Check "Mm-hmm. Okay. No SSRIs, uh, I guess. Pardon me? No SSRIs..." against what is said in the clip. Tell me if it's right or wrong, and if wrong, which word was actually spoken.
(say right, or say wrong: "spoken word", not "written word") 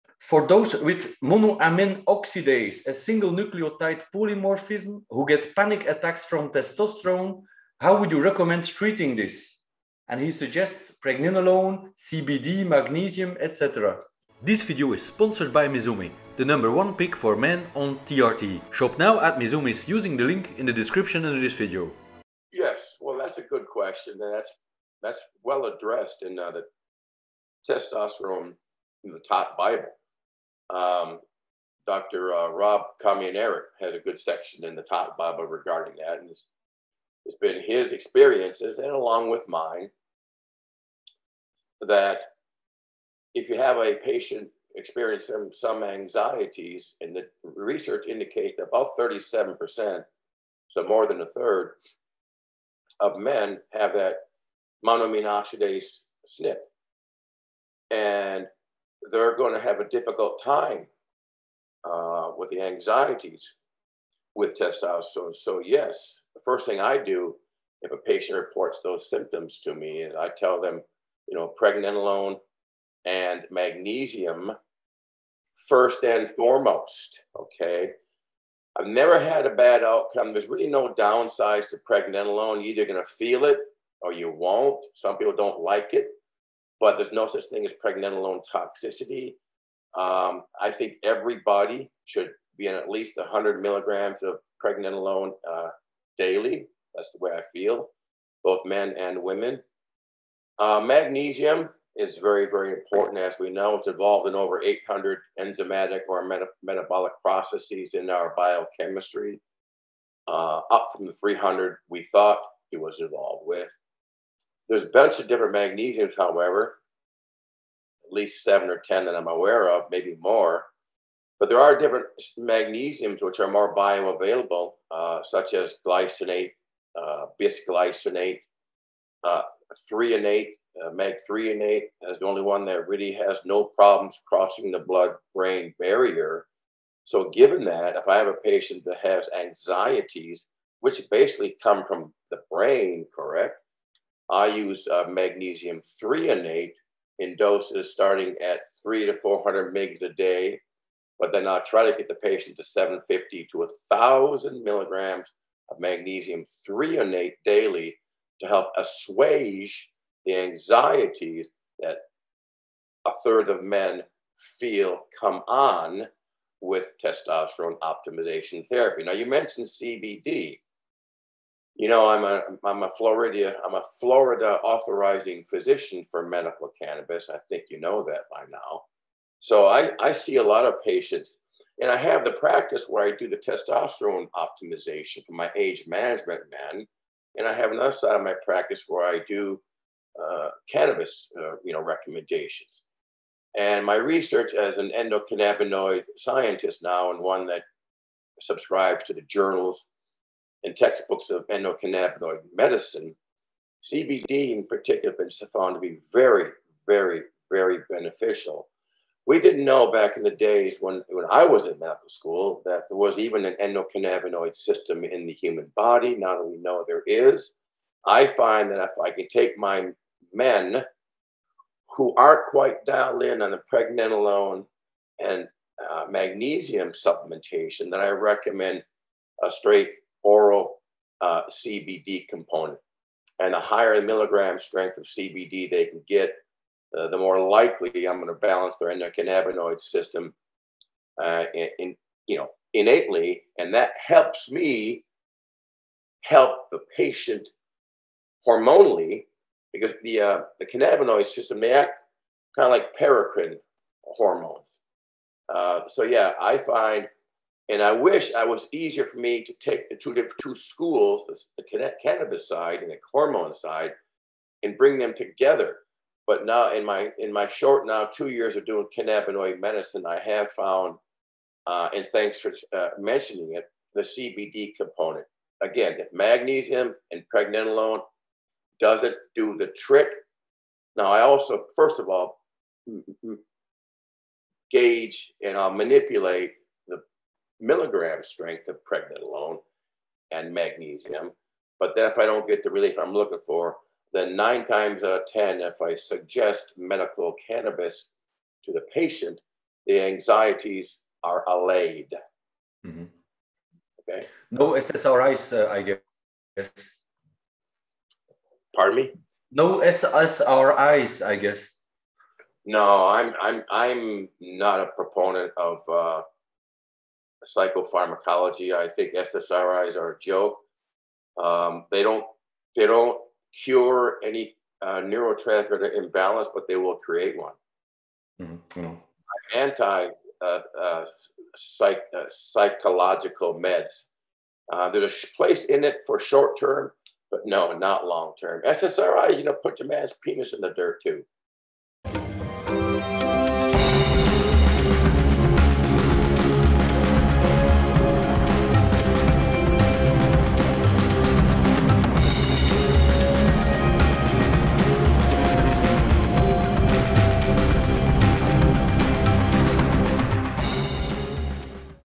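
right.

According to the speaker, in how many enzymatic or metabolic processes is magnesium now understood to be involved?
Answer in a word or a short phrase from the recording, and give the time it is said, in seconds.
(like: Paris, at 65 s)
800, at 104 s.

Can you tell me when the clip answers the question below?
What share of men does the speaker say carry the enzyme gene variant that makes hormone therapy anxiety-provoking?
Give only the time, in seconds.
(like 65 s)
48 s.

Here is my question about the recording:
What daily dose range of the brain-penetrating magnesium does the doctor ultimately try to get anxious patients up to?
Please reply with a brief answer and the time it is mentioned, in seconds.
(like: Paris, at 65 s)
750 to 1,000 milligrams, at 152 s.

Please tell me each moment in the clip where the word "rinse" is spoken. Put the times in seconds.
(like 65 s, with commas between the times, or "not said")
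not said.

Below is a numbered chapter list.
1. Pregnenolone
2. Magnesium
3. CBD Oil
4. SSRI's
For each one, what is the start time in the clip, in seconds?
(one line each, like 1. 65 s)
1. 66 s
2. 100 s
3. 169 s
4. 303 s.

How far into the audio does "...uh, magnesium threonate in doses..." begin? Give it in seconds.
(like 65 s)
144 s.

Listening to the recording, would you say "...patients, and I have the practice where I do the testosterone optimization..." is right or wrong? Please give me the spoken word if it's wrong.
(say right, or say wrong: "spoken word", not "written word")
right.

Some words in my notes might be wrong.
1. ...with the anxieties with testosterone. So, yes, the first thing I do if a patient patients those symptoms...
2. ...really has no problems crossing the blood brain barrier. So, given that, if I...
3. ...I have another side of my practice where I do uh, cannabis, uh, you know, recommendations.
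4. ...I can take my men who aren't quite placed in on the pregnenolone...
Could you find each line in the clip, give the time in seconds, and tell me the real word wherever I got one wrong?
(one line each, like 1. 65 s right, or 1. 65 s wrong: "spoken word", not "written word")
1. 62 s wrong: "reports", not "patients"
2. 132 s right
3. 187 s right
4. 219 s wrong: "dialed", not "placed".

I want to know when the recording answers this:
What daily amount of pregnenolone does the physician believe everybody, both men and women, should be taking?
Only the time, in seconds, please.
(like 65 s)
93 s.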